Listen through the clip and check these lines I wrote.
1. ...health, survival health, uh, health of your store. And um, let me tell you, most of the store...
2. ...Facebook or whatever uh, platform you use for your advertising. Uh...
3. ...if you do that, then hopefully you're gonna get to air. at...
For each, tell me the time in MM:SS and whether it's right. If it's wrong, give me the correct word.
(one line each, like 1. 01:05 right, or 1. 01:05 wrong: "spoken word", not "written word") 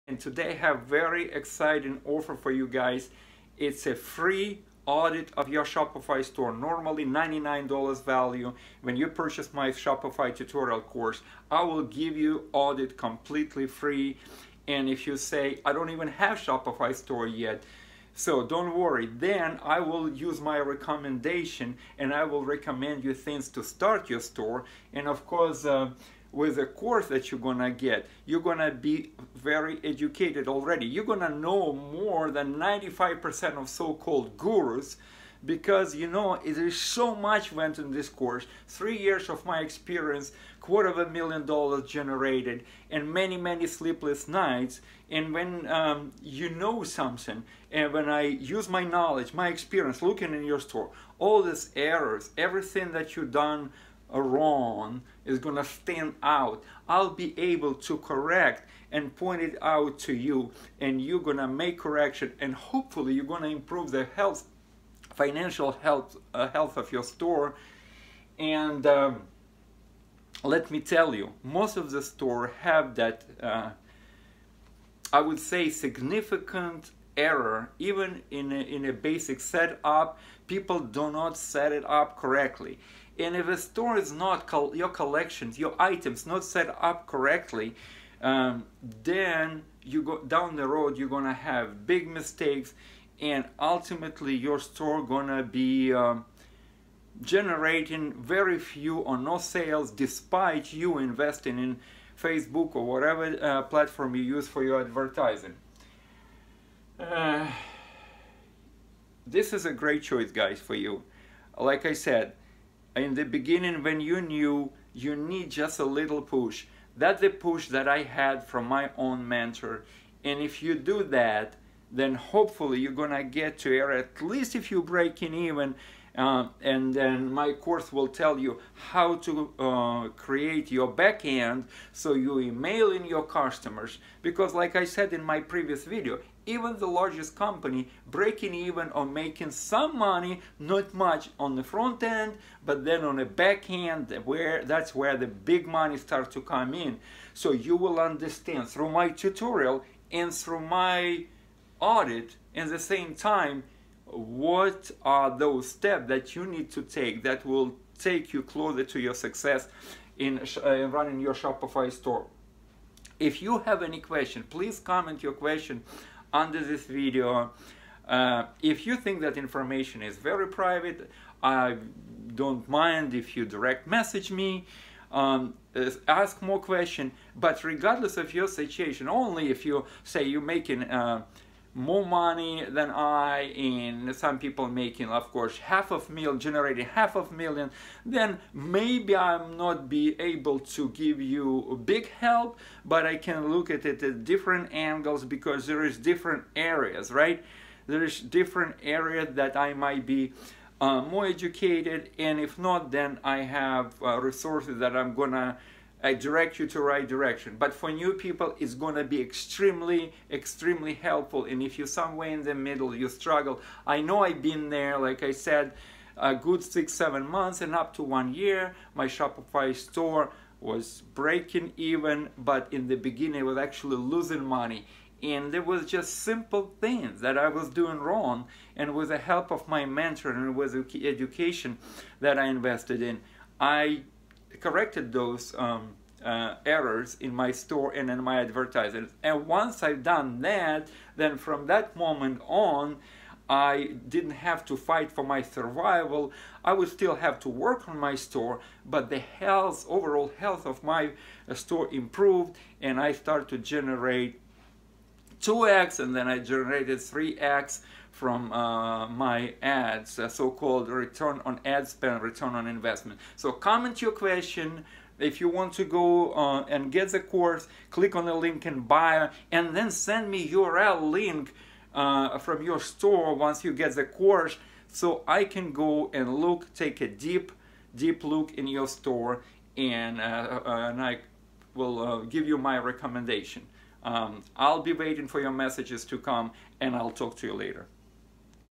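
1. 01:04 wrong: "financial", not "survival"
2. 01:42 right
3. 02:00 right.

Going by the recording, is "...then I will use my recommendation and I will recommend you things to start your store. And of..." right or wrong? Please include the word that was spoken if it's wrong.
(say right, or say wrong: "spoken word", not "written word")
right.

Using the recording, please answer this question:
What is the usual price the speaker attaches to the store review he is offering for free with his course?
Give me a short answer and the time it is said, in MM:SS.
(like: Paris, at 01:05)
$99, at 00:07.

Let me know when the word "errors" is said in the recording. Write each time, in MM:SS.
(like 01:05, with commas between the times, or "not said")
00:51, 01:17, 03:56.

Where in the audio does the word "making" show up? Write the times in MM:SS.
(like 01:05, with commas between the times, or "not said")
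02:19, 03:00, 03:04.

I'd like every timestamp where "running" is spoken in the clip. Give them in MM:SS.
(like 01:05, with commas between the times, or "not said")
02:40.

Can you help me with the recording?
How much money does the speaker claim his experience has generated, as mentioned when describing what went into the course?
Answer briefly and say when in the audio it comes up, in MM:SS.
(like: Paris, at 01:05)
quarter of a million dollars, at 00:40.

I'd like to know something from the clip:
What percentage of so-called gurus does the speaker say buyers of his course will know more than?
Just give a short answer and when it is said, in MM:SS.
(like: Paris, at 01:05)
95%, at 00:32.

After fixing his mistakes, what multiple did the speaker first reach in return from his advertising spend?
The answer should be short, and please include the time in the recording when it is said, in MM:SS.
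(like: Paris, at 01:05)
2x, at 04:15.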